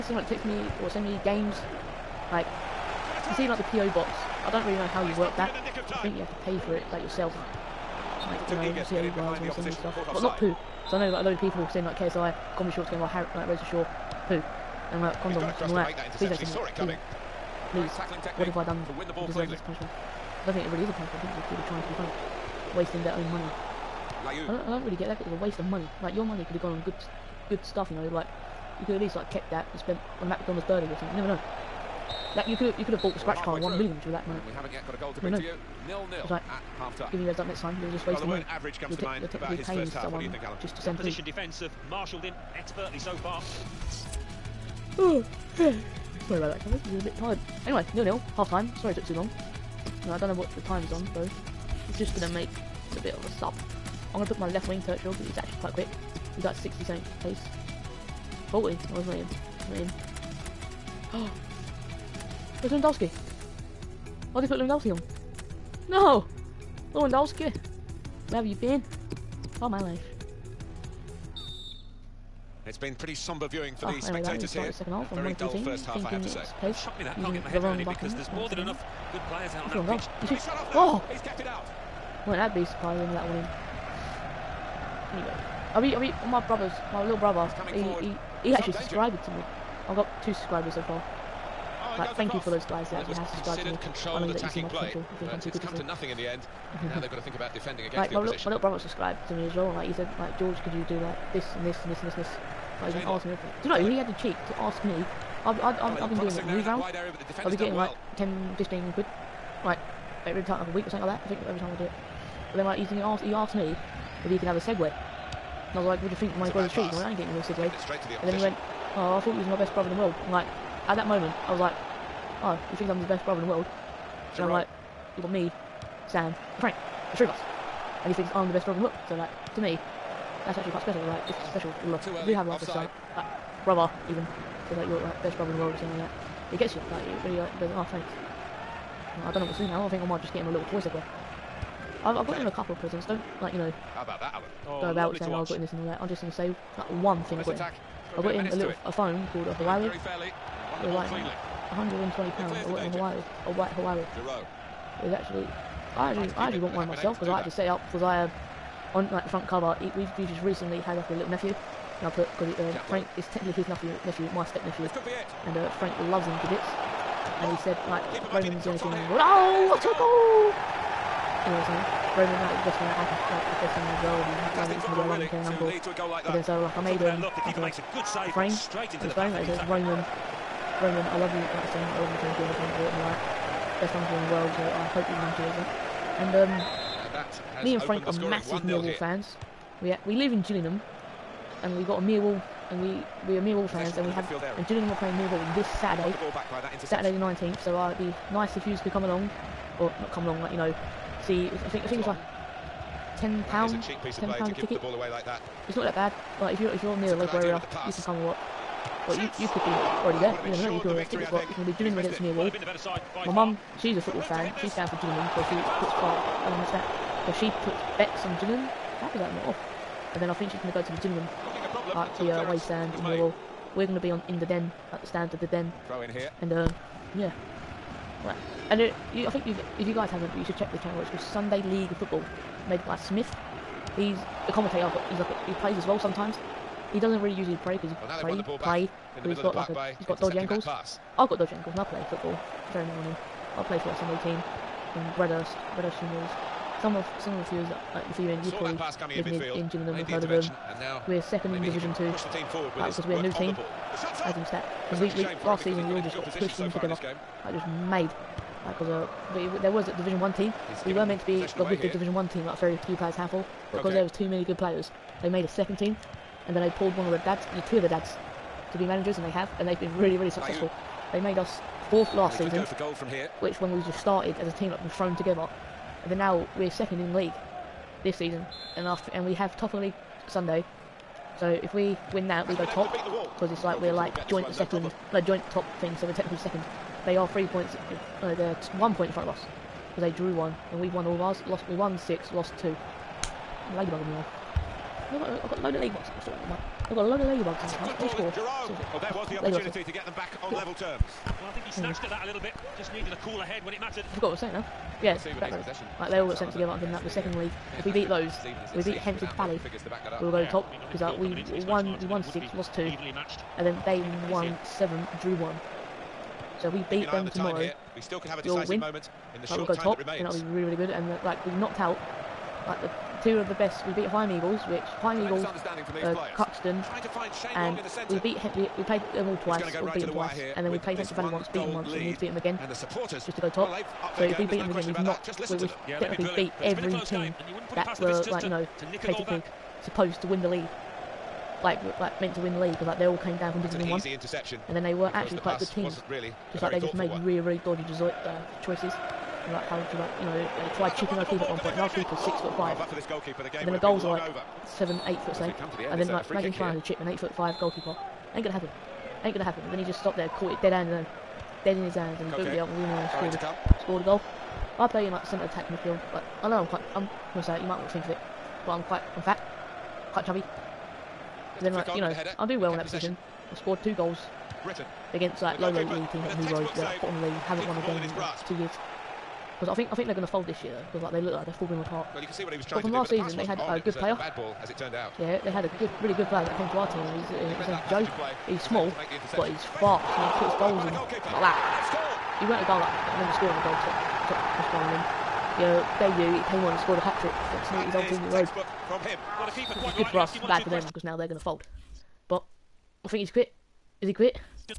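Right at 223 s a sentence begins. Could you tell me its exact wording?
We're going to be on in the den, at the stand of the den.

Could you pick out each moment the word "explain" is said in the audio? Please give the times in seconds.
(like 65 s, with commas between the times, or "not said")
not said.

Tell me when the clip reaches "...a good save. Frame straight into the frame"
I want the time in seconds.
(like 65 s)
177 s.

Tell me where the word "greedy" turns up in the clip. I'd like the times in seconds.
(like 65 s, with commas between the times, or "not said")
not said.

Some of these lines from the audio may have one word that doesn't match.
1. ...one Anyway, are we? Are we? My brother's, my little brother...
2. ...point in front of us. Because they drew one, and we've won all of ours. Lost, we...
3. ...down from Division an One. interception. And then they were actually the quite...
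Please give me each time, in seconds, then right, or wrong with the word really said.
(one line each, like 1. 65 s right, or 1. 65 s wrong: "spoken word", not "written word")
1. 83 s right
2. 288 s right
3. 343 s right.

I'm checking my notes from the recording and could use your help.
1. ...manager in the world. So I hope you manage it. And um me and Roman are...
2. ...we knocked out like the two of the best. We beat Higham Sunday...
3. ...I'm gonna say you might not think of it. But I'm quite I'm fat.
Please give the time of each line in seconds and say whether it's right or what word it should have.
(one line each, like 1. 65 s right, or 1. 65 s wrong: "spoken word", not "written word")
1. 183 s wrong: "Frank", not "Roman"
2. 321 s wrong: "Eagles", not "Sunday"
3. 366 s right.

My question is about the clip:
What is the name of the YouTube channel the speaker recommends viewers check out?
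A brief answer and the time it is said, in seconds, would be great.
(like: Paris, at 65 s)
Sunday League Football, at 231 s.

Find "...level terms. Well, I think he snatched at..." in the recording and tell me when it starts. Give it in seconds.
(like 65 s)
300 s.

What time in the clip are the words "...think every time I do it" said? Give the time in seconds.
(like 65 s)
111 s.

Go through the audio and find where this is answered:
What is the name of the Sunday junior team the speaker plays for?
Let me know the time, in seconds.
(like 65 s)
245 s.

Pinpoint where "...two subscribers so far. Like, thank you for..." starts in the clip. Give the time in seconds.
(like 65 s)
90 s.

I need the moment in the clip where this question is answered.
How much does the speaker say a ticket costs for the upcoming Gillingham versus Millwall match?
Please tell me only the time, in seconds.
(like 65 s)
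203 s.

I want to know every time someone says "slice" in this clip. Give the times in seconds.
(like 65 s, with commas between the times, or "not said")
not said.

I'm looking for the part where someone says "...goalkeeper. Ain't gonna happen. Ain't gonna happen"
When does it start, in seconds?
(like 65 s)
357 s.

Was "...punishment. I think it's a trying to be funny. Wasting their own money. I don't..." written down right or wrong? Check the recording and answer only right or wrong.
right.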